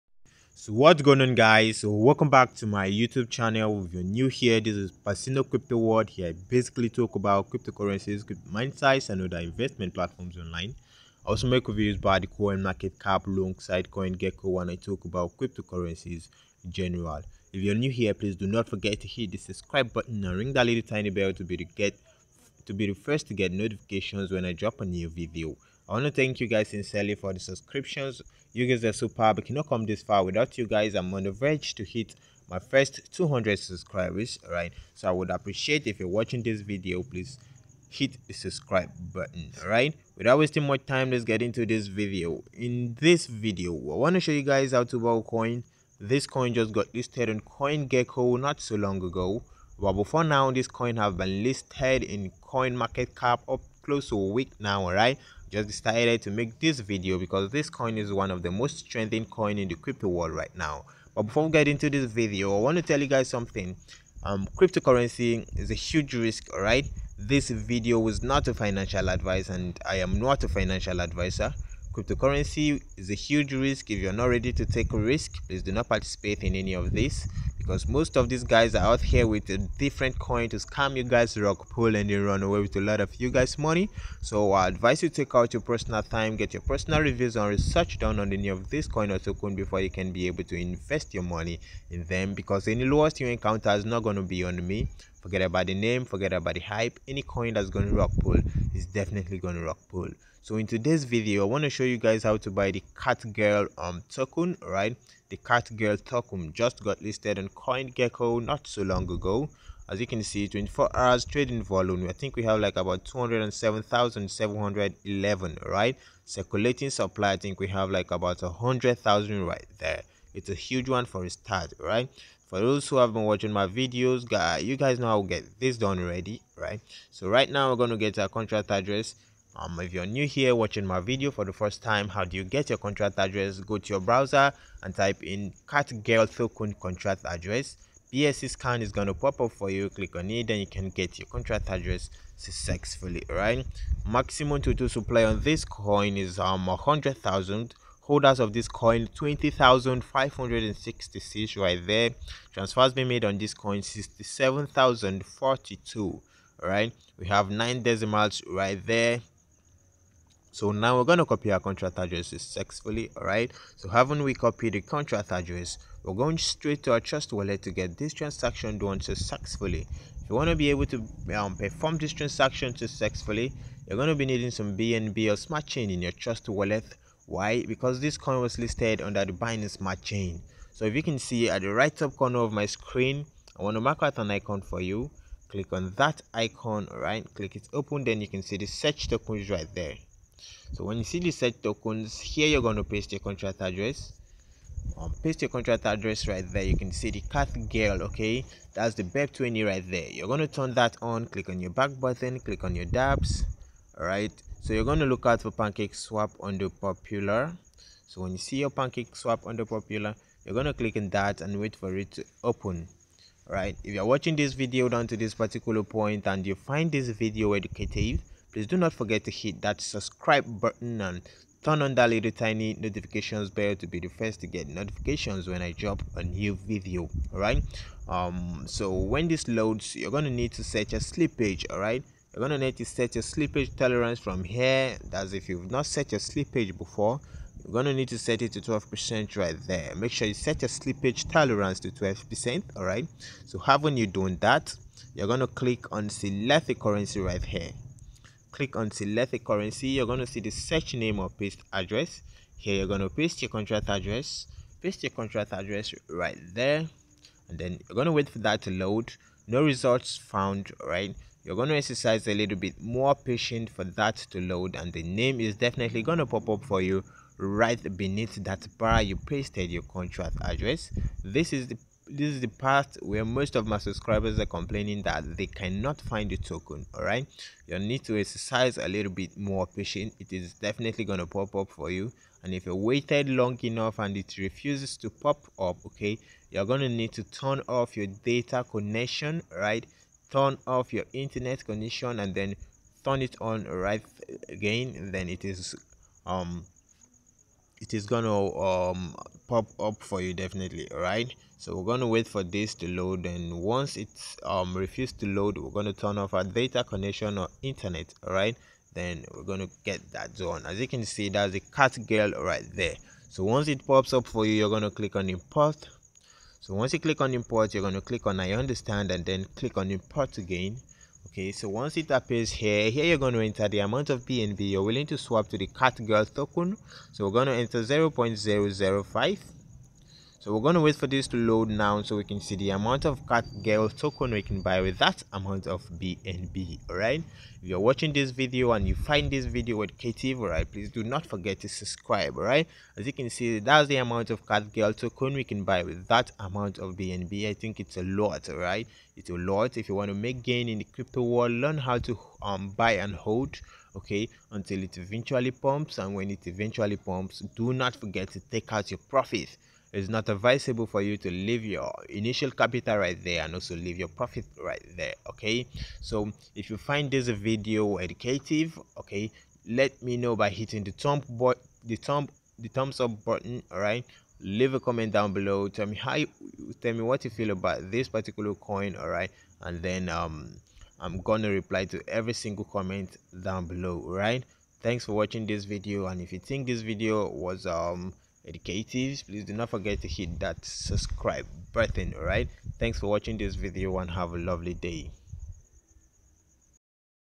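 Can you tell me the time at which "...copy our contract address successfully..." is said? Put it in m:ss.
2:41.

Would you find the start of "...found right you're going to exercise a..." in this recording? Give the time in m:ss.
4:20.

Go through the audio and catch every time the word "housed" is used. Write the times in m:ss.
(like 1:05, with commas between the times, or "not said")
not said.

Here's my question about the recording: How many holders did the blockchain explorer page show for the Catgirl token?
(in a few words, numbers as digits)
20,566.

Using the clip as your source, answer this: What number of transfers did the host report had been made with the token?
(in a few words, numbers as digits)
67,042.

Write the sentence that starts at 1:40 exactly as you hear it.
So in today's video, I want to show you guys how to buy the Cat um token, right?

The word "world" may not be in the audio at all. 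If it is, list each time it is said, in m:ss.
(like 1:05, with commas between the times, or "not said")
0:05, 1:00, 5:51.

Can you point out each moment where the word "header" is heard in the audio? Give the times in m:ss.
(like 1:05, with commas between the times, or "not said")
not said.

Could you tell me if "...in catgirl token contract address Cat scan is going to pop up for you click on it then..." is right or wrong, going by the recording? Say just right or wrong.
wrong.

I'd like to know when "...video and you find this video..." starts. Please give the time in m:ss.
5:38.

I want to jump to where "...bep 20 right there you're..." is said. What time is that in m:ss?
3:19.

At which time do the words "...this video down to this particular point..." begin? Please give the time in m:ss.
3:34.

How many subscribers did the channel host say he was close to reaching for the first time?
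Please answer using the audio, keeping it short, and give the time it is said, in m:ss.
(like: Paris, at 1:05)
200, at 0:33.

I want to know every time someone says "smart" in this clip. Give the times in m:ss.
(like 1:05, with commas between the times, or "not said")
2:55, 2:59.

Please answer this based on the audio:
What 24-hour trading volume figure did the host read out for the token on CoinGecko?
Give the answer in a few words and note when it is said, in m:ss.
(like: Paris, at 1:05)
207,711, at 1:53.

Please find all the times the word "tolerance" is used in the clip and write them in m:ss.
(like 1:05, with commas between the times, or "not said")
3:53, 4:01.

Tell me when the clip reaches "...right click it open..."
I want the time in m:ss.
3:06.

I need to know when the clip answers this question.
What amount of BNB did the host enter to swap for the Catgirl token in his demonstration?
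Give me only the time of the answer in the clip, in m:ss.
5:27.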